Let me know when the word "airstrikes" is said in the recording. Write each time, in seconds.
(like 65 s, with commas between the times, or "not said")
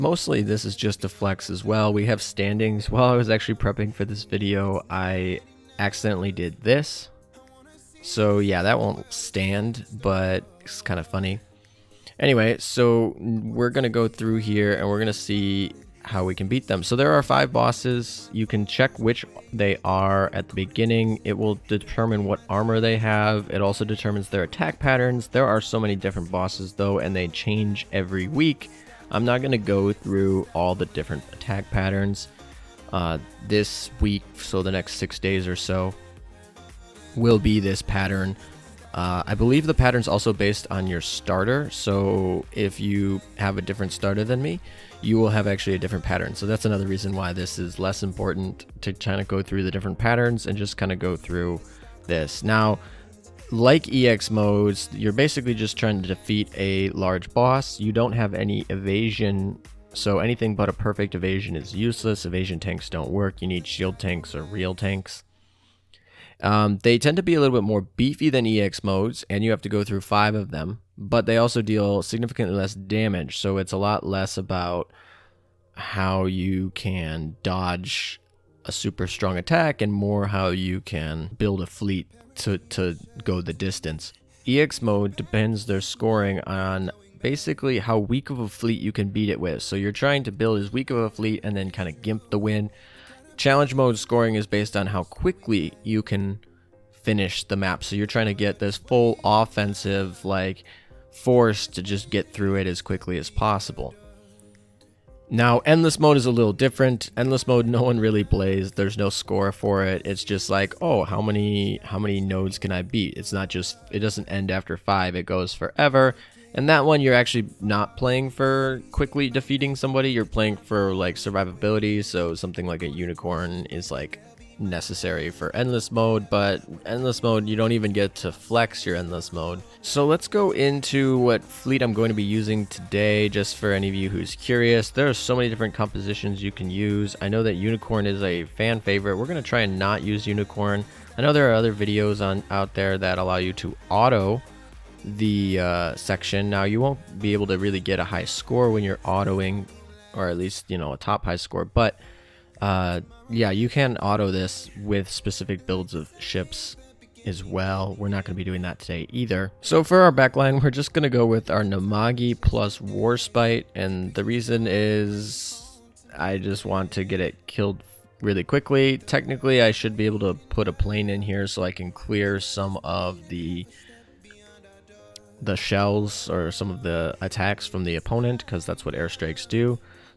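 178 s.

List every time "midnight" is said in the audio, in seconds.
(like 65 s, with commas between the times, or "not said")
not said.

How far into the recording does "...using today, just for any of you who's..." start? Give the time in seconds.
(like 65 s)
132 s.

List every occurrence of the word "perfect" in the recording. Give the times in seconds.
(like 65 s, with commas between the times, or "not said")
60 s.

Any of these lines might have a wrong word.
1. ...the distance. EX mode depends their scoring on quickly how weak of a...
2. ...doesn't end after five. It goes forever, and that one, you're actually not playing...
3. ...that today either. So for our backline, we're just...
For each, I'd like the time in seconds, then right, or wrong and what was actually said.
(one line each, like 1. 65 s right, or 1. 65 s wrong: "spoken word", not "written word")
1. 83 s wrong: "basically", not "quickly"
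2. 113 s right
3. 158 s right.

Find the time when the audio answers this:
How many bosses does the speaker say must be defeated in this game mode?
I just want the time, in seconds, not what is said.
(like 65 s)
17 s.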